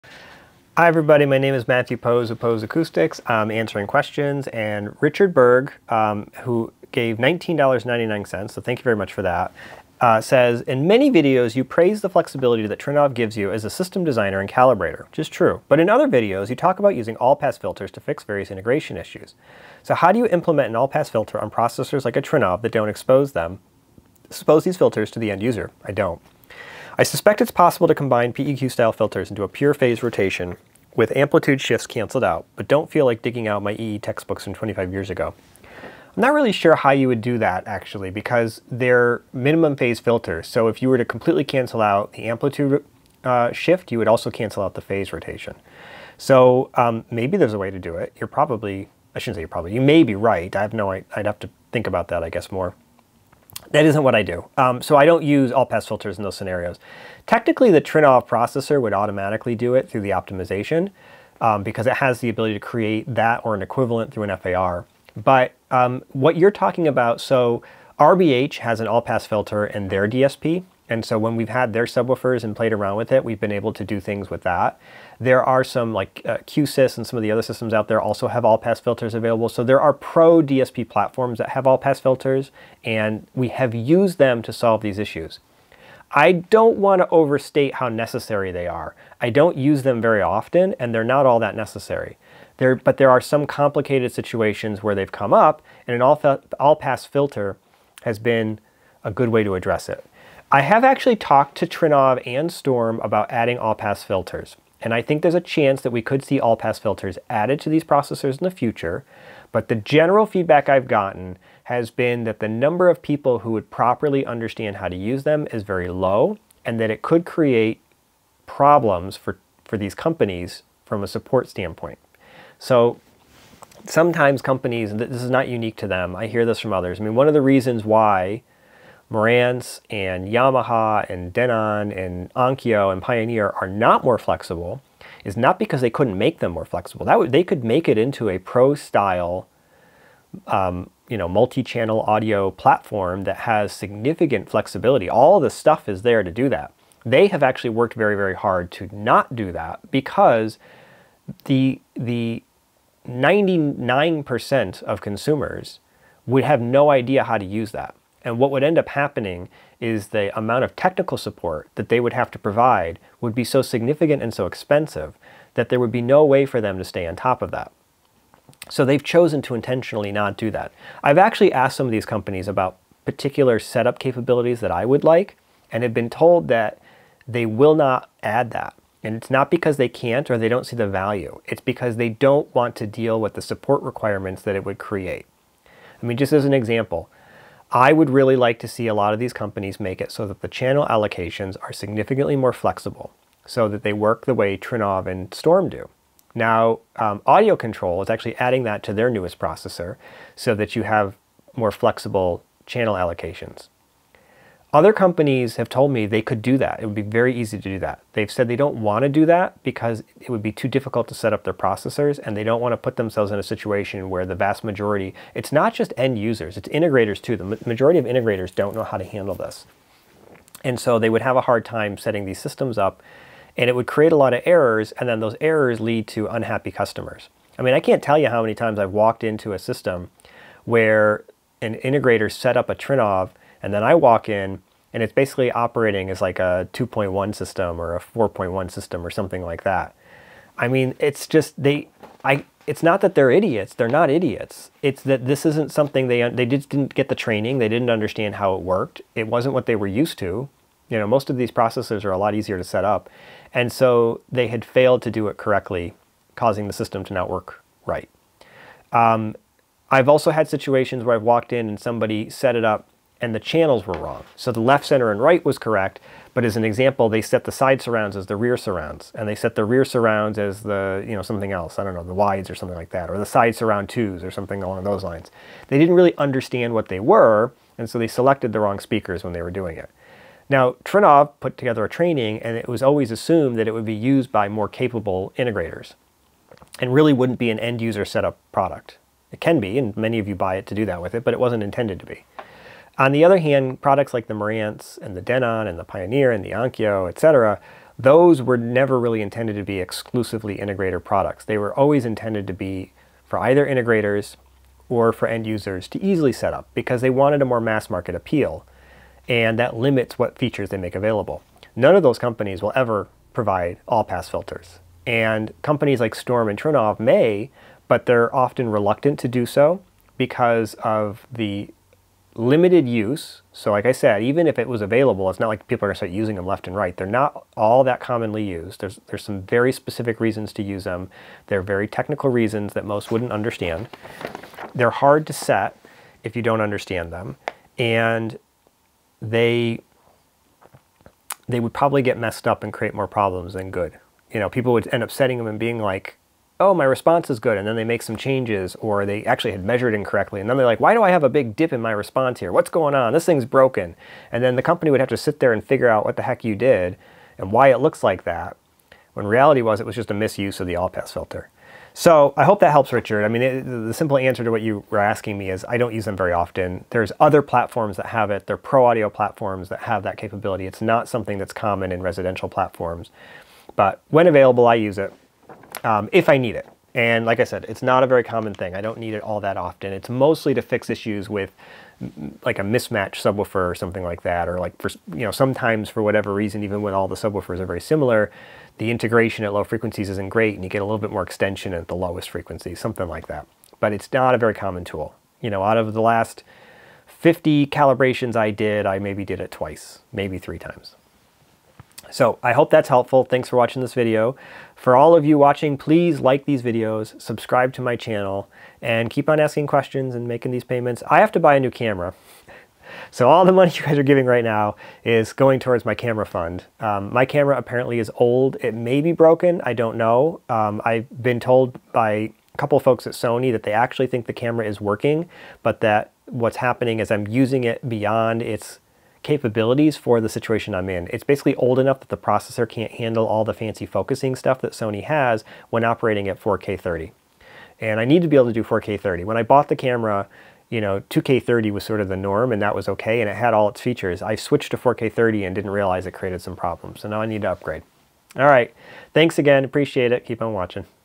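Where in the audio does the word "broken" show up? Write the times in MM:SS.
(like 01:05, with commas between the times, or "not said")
05:53, 06:59.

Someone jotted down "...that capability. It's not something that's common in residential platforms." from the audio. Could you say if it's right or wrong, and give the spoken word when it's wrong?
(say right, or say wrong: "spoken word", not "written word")
right.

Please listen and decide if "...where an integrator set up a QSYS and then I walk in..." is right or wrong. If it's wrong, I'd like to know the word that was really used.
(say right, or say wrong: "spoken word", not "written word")
wrong: "Trinnov", not "QSYS".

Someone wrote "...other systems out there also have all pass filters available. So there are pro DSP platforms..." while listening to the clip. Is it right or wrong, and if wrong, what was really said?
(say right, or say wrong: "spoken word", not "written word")
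right.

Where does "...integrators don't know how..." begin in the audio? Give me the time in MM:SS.
03:38.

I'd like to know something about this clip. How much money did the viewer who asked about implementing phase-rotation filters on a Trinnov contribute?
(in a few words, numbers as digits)
$19.99.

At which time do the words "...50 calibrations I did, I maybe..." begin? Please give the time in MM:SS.
06:37.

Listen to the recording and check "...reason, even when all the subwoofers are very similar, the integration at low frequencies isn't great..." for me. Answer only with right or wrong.
right.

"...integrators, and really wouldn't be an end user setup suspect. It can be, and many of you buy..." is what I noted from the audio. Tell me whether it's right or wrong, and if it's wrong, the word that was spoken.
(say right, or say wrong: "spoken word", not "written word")
wrong: "product", not "suspect".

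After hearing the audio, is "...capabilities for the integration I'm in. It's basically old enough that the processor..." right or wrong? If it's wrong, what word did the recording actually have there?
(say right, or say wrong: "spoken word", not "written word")
wrong: "situation", not "integration".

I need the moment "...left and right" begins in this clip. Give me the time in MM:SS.
05:26.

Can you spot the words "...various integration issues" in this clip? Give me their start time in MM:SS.
00:18.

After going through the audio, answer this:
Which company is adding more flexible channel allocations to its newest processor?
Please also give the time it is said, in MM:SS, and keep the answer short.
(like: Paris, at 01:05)
Audio Control, at 03:17.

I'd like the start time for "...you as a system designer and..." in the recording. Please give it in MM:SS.
00:13.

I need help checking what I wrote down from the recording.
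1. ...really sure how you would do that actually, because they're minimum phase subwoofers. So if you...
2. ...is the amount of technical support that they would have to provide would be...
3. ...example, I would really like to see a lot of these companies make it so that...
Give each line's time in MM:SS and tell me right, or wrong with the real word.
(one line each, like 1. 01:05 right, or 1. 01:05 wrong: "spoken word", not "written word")
1. 00:36 wrong: "filters", not "subwoofers"
2. 02:39 right
3. 03:06 right.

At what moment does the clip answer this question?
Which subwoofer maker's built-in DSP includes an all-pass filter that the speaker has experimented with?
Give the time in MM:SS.
01:07.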